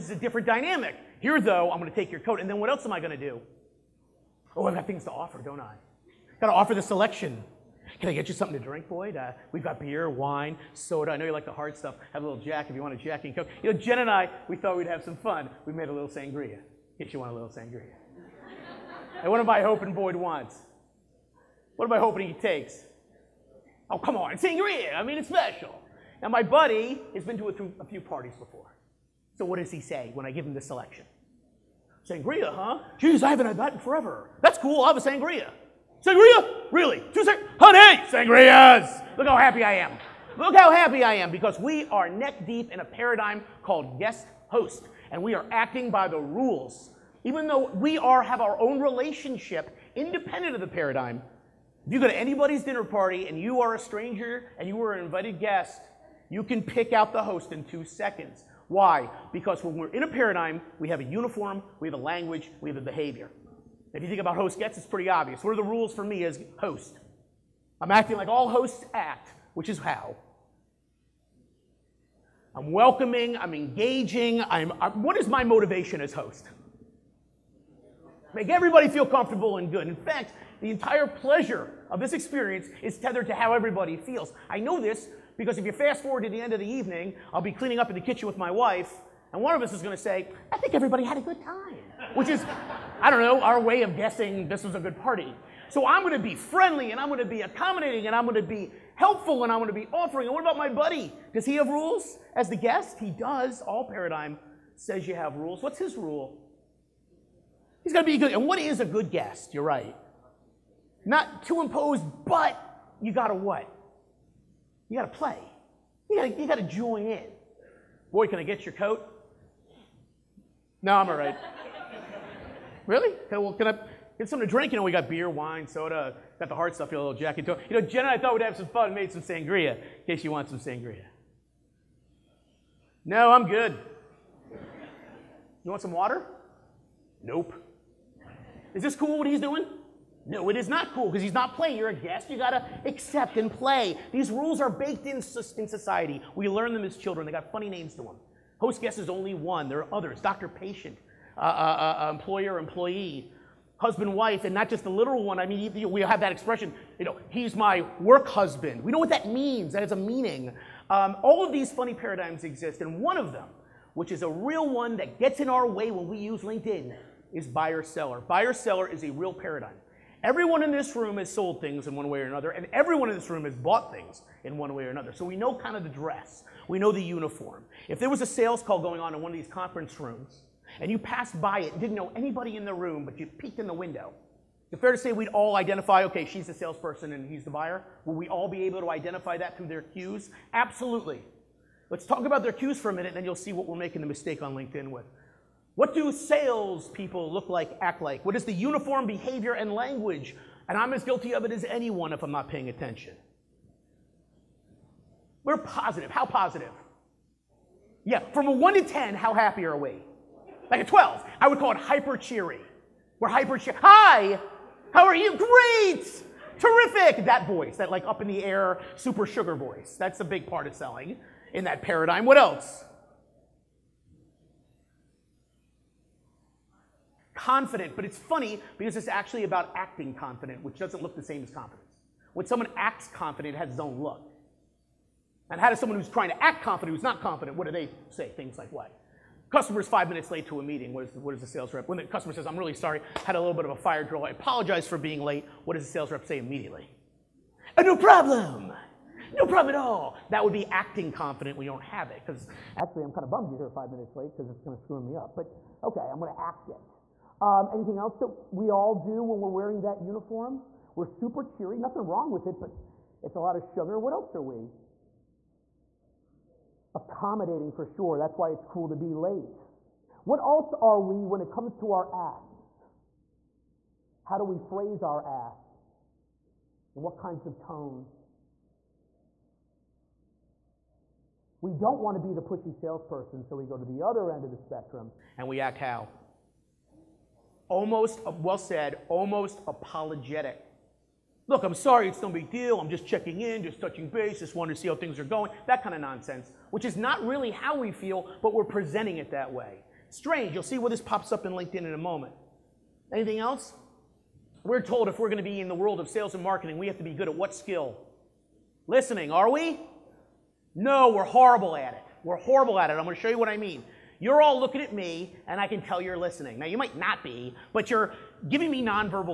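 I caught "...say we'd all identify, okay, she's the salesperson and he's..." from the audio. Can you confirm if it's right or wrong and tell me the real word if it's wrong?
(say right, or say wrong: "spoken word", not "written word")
right.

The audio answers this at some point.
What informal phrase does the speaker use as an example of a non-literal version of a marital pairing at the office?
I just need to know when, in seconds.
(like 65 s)
157 s.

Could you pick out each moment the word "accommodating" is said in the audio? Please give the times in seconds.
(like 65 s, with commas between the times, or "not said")
97 s, 266 s.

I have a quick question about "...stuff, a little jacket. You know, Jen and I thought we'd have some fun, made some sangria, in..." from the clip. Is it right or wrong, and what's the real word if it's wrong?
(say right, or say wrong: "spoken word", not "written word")
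right.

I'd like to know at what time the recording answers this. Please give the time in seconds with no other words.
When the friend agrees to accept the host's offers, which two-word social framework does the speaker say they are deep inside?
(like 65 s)
43 s.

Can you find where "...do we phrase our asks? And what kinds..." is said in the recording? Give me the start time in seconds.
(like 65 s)
274 s.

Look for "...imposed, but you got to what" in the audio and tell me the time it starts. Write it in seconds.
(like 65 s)
111 s.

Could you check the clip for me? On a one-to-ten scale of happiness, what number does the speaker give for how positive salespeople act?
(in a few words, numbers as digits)
12.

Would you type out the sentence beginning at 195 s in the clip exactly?
What do salespeople look like, act like?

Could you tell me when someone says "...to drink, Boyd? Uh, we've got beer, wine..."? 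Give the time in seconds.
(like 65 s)
8 s.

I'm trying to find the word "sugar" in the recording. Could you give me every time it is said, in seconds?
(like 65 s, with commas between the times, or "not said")
219 s, 263 s.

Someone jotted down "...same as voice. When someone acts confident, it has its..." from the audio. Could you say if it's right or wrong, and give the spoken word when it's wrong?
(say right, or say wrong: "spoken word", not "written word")
wrong: "confidence", not "voice".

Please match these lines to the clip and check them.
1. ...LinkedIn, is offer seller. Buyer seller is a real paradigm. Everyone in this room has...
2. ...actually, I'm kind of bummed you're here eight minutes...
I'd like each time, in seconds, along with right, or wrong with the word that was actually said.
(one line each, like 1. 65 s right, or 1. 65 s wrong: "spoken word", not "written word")
1. 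166 s wrong: "buyer", not "offer"
2. 252 s wrong: "five", not "eight".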